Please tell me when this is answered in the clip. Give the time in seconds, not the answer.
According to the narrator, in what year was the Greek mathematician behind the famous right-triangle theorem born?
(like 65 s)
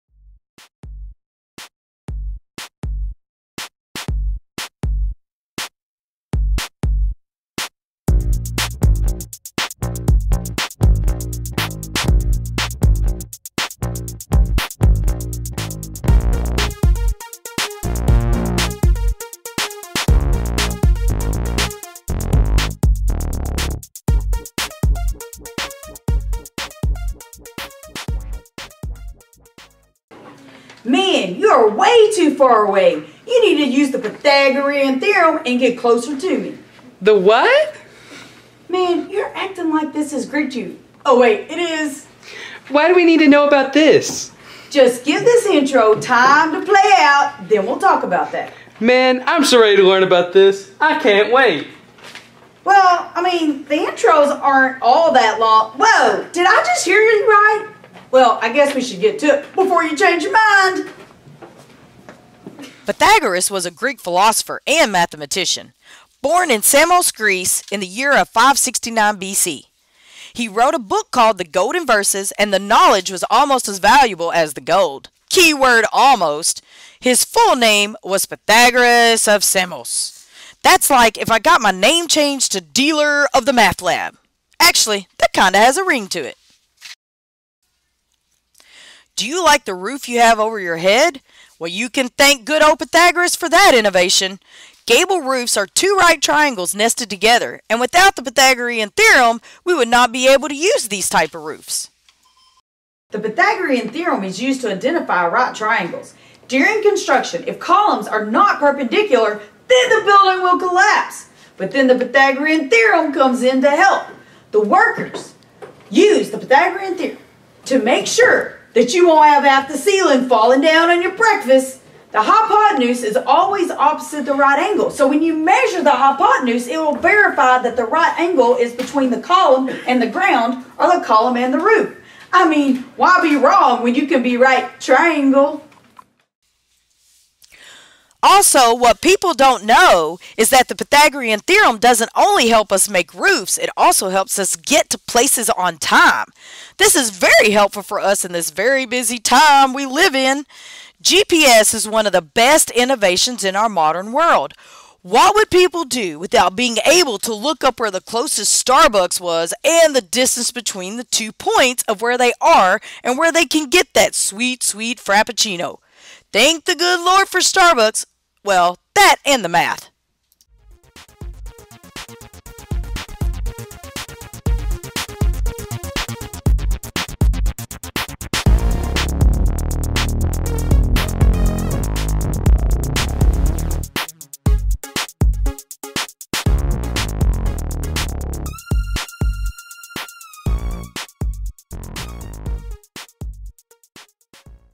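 68 s.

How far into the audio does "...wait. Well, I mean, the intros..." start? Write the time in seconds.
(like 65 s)
51 s.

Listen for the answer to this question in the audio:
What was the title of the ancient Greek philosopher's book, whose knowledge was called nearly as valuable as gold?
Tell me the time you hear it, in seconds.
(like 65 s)
71 s.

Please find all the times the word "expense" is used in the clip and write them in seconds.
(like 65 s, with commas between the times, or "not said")
not said.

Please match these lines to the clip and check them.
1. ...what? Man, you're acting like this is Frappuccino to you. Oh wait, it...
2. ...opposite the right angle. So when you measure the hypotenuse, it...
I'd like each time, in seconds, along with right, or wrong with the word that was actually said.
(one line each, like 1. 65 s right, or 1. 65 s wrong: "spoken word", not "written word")
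1. 37 s wrong: "Greek", not "Frappuccino"
2. 123 s right.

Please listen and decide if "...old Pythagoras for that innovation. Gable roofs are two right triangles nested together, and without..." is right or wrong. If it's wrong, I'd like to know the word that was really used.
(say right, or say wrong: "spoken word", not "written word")
right.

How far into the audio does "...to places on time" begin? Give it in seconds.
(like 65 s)
144 s.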